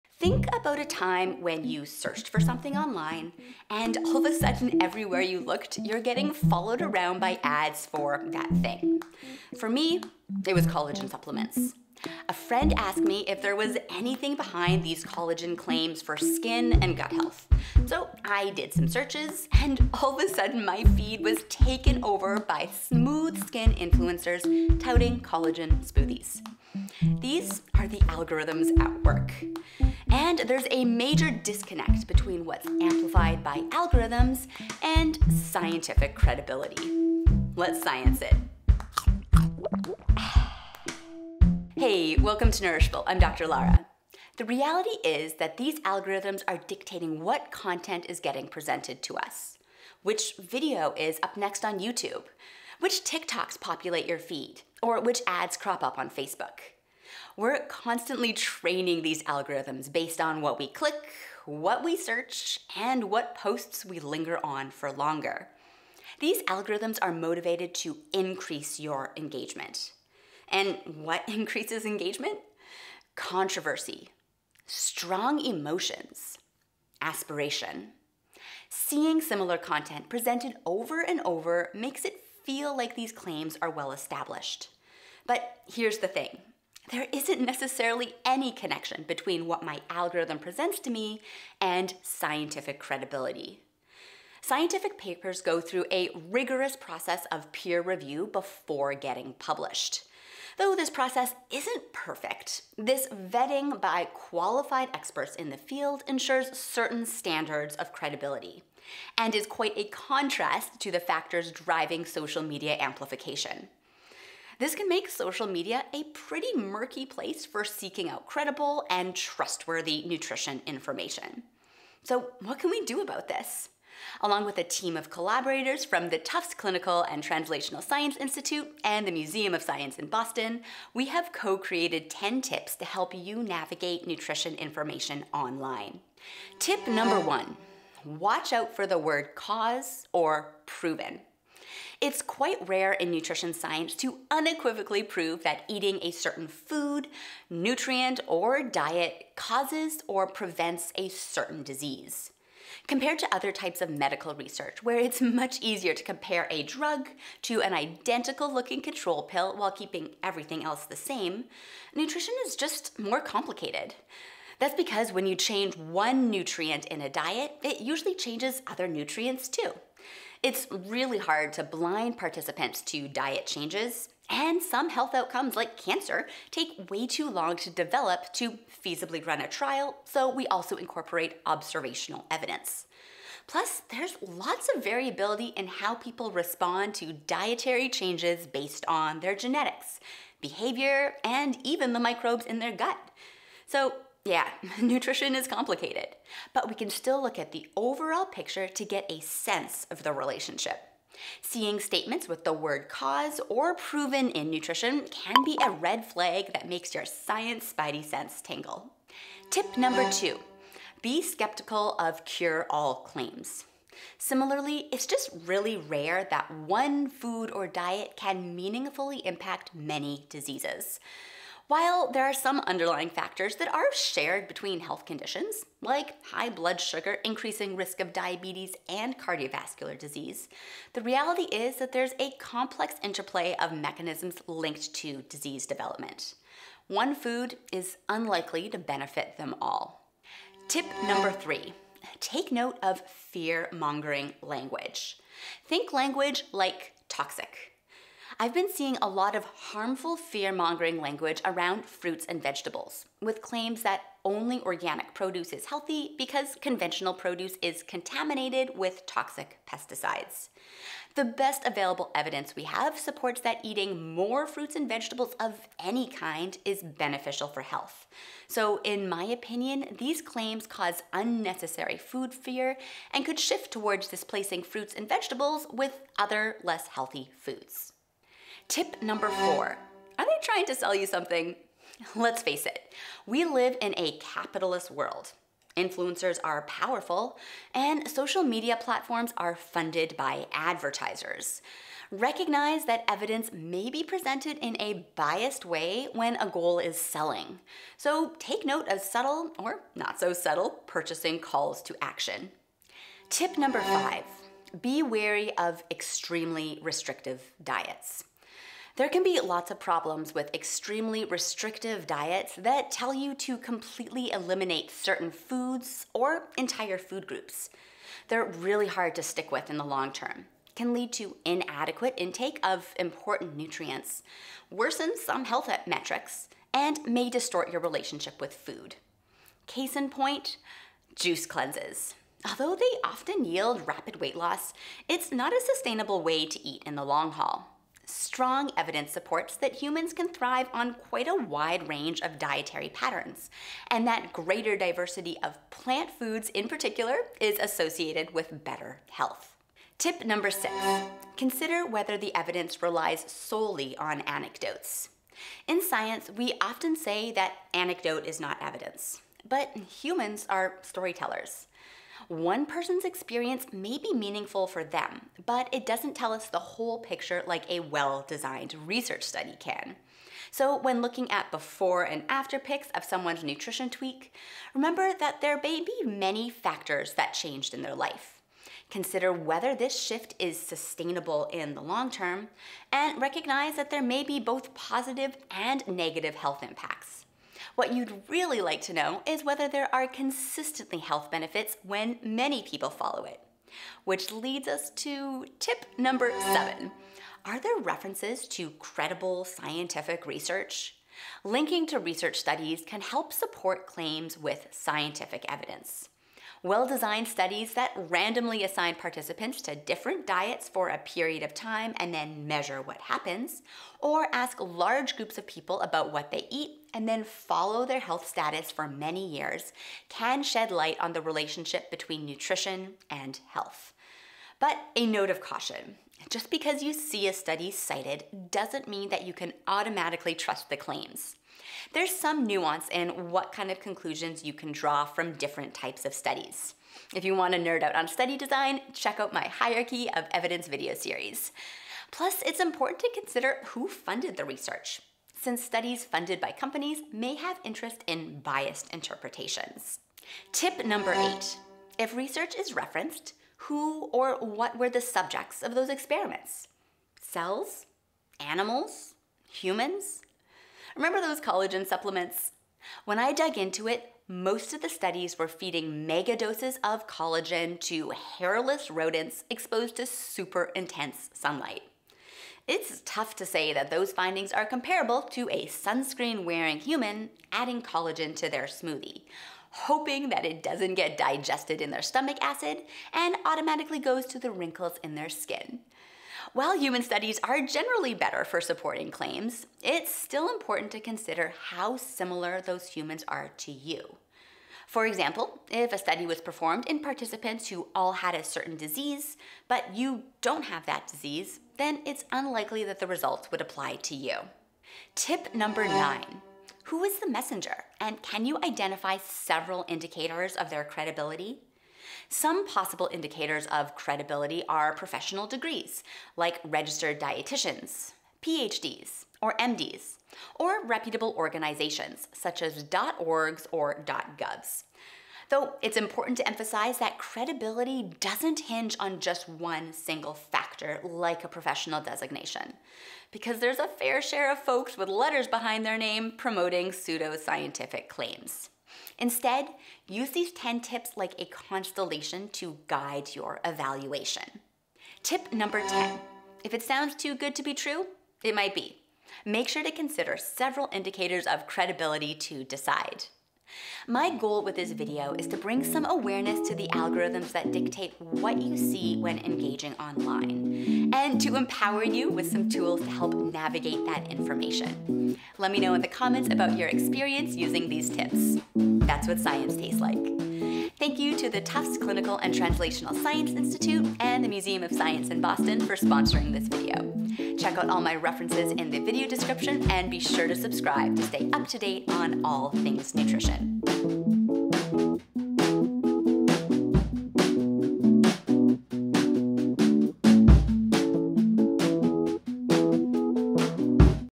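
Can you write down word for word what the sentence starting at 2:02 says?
So, what can we do about this?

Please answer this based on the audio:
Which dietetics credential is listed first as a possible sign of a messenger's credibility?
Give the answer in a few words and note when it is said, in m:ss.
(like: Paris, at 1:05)
Registered dietitians, at 8:36.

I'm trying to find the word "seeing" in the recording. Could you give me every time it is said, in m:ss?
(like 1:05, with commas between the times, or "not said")
1:18, 3:21, 4:08.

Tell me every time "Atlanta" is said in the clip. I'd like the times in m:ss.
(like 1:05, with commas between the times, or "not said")
not said.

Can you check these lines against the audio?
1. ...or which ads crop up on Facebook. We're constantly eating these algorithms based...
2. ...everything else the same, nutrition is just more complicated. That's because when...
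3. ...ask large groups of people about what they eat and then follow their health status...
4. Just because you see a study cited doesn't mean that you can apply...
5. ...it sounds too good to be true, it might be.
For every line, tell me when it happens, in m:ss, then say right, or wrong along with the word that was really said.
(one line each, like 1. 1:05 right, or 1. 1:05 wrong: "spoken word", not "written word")
1. 0:54 wrong: "training", not "eating"
2. 2:40 right
3. 6:54 right
4. 7:06 wrong: "automatically", not "apply"
5. 9:06 right.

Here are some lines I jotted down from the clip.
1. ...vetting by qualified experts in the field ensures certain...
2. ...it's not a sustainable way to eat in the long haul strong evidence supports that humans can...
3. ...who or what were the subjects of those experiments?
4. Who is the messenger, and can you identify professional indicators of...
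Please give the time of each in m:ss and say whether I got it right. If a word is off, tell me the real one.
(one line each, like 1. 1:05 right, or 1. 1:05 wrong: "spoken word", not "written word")
1. 1:43 right
2. 5:35 right
3. 7:33 right
4. 8:26 wrong: "several", not "professional".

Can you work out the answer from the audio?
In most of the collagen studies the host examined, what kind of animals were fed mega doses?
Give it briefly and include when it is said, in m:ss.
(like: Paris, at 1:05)
Hairless rodents, at 7:48.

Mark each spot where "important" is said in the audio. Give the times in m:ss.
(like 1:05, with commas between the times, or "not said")
5:22, 7:22, 8:10, 8:45.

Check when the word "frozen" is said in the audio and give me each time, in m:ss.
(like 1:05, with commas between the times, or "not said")
not said.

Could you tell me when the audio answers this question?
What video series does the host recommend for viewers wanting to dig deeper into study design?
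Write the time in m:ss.
7:19.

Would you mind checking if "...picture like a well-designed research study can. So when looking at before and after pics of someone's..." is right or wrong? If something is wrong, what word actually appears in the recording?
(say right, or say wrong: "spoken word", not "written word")
right.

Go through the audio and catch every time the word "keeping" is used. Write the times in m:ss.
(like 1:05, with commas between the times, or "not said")
2:39.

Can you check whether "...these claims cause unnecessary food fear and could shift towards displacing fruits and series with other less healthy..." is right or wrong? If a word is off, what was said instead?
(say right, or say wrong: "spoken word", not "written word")
wrong: "vegetables", not "series".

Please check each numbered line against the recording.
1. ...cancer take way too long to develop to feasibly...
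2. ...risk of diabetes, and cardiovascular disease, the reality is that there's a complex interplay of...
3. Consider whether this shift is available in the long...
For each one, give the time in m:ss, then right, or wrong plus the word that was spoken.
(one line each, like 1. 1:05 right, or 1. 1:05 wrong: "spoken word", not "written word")
1. 2:55 right
2. 3:47 right
3. 6:18 wrong: "sustainable", not "available".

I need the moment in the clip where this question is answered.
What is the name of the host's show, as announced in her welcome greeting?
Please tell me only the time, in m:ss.
0:42.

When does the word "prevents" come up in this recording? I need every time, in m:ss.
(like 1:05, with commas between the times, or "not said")
2:30.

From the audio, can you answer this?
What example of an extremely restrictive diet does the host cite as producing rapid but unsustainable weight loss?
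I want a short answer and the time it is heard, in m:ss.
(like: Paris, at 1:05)
Juice cleanses, at 5:31.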